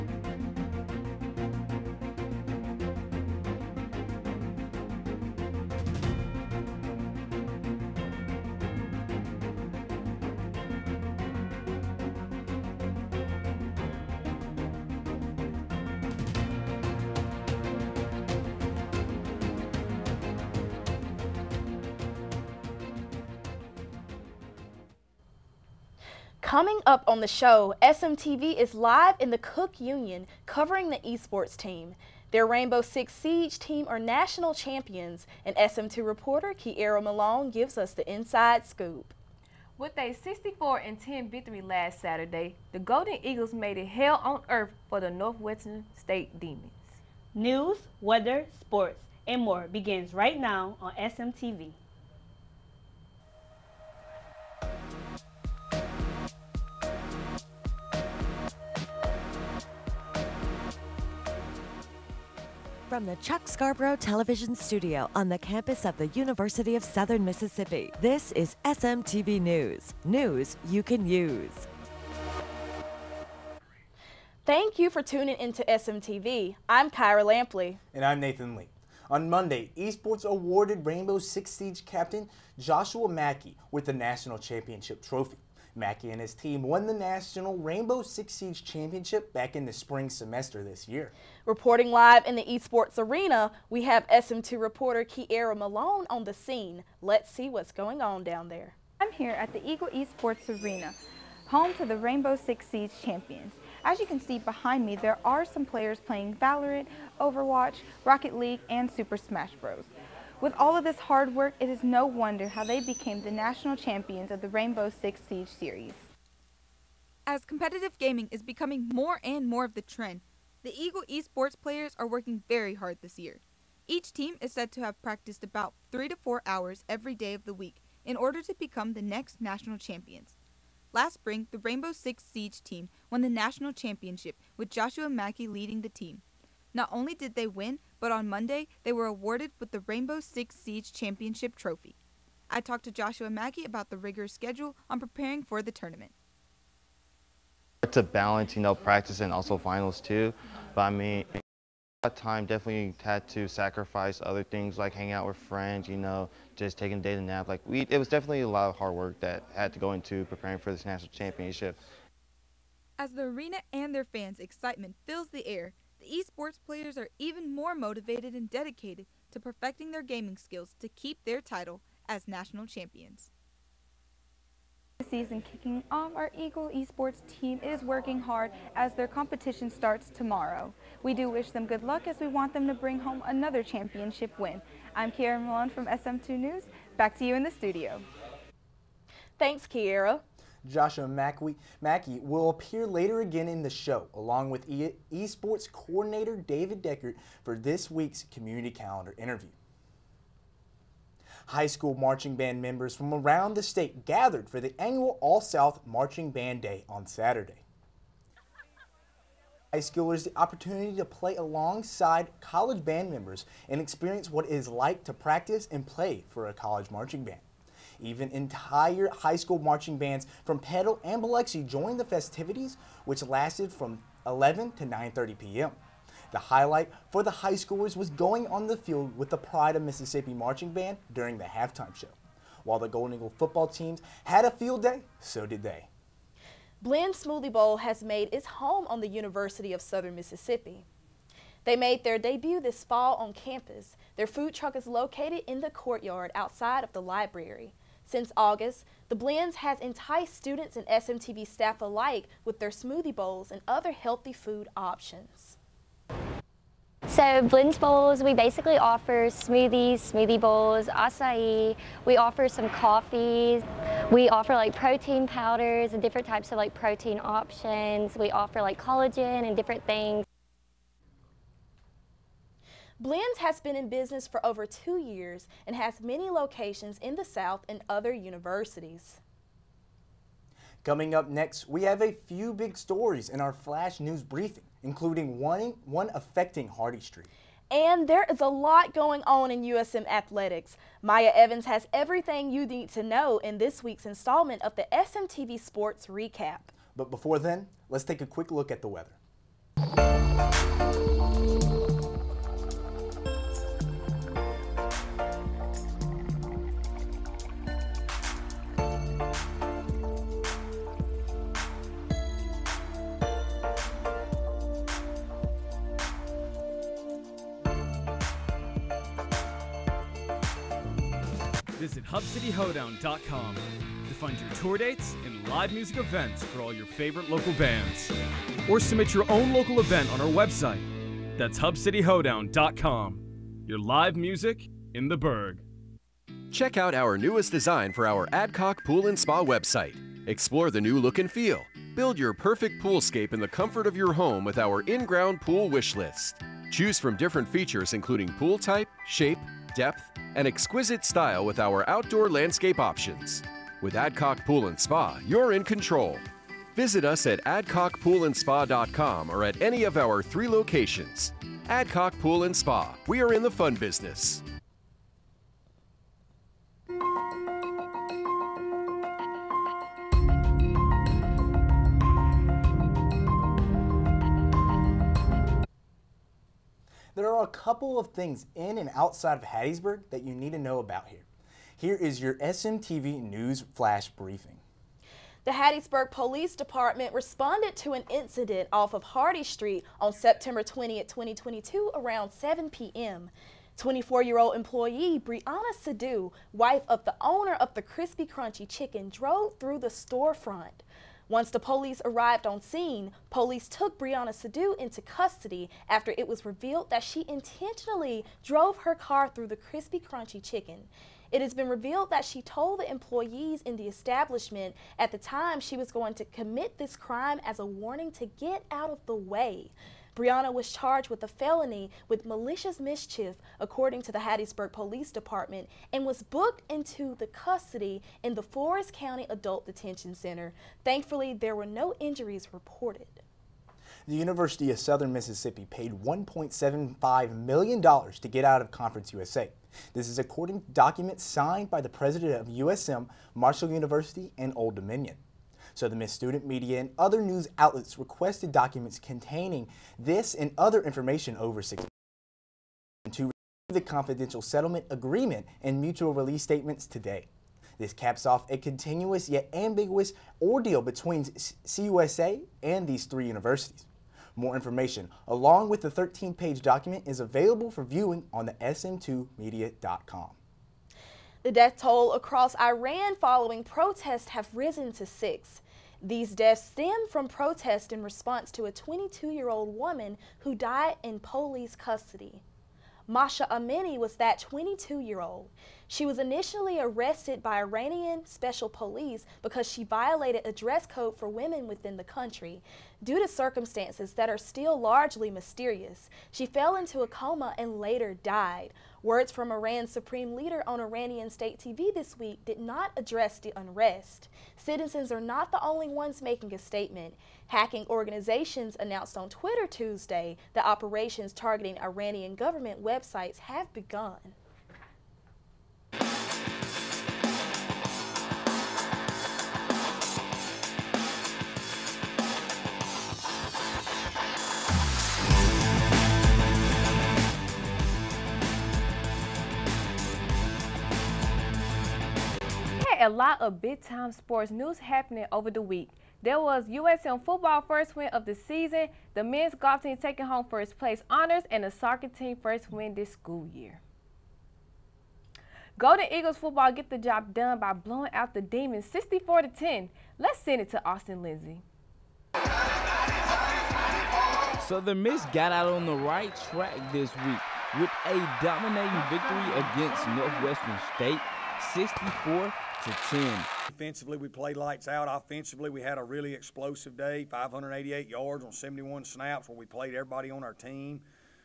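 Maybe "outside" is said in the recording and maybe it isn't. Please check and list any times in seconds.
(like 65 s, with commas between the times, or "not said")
246 s, 378 s.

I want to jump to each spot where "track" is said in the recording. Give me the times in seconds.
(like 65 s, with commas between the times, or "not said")
556 s.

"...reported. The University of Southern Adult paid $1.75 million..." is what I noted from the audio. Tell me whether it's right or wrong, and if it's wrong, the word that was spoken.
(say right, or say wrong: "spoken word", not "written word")
wrong: "Mississippi", not "Adult".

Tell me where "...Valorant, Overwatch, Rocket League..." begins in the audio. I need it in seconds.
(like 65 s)
106 s.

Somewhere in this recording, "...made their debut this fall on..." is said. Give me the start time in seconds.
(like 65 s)
241 s.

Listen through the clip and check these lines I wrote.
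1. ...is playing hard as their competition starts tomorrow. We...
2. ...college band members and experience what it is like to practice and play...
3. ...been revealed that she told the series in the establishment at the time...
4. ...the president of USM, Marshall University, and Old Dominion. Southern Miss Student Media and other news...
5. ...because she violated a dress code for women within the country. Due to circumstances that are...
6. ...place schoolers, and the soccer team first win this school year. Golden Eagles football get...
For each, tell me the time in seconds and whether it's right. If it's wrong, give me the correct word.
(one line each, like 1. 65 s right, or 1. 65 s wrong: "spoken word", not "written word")
1. 177 s wrong: "working", not "playing"
2. 212 s right
3. 411 s wrong: "employees", not "series"
4. 441 s right
5. 489 s right
6. 540 s wrong: "honors", not "schoolers".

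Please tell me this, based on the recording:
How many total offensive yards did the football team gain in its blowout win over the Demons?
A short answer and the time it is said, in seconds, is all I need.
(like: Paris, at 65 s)
588, at 567 s.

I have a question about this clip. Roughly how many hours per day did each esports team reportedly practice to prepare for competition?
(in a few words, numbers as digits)
3 to 4.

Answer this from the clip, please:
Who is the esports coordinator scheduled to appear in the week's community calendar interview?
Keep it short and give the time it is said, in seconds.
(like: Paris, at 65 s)
David Deckert, at 196 s.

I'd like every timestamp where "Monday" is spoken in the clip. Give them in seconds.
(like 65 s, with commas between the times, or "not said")
79 s, 138 s.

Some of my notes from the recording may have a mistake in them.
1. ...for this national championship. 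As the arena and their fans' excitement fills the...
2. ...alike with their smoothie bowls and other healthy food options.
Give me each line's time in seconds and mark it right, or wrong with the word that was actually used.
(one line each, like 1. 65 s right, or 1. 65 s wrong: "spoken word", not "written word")
1. 160 s right
2. 251 s right.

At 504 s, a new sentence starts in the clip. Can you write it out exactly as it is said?
Citizens are not the only ones making a statement.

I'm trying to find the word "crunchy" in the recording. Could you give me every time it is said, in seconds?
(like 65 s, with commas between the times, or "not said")
398 s, 409 s.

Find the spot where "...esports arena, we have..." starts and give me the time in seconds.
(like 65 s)
92 s.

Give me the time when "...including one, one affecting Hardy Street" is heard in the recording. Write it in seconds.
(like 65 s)
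284 s.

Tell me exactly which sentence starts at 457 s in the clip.
This caps off a continuous yet ambiguous ordeal between CUSA and these three universities.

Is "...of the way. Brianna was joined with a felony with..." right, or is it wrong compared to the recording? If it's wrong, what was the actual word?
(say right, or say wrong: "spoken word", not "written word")
wrong: "charged", not "joined".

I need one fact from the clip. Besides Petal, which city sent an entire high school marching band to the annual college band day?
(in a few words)
Biloxi.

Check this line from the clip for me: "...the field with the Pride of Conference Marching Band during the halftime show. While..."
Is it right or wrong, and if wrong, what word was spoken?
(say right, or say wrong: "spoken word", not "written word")
wrong: "Mississippi", not "Conference".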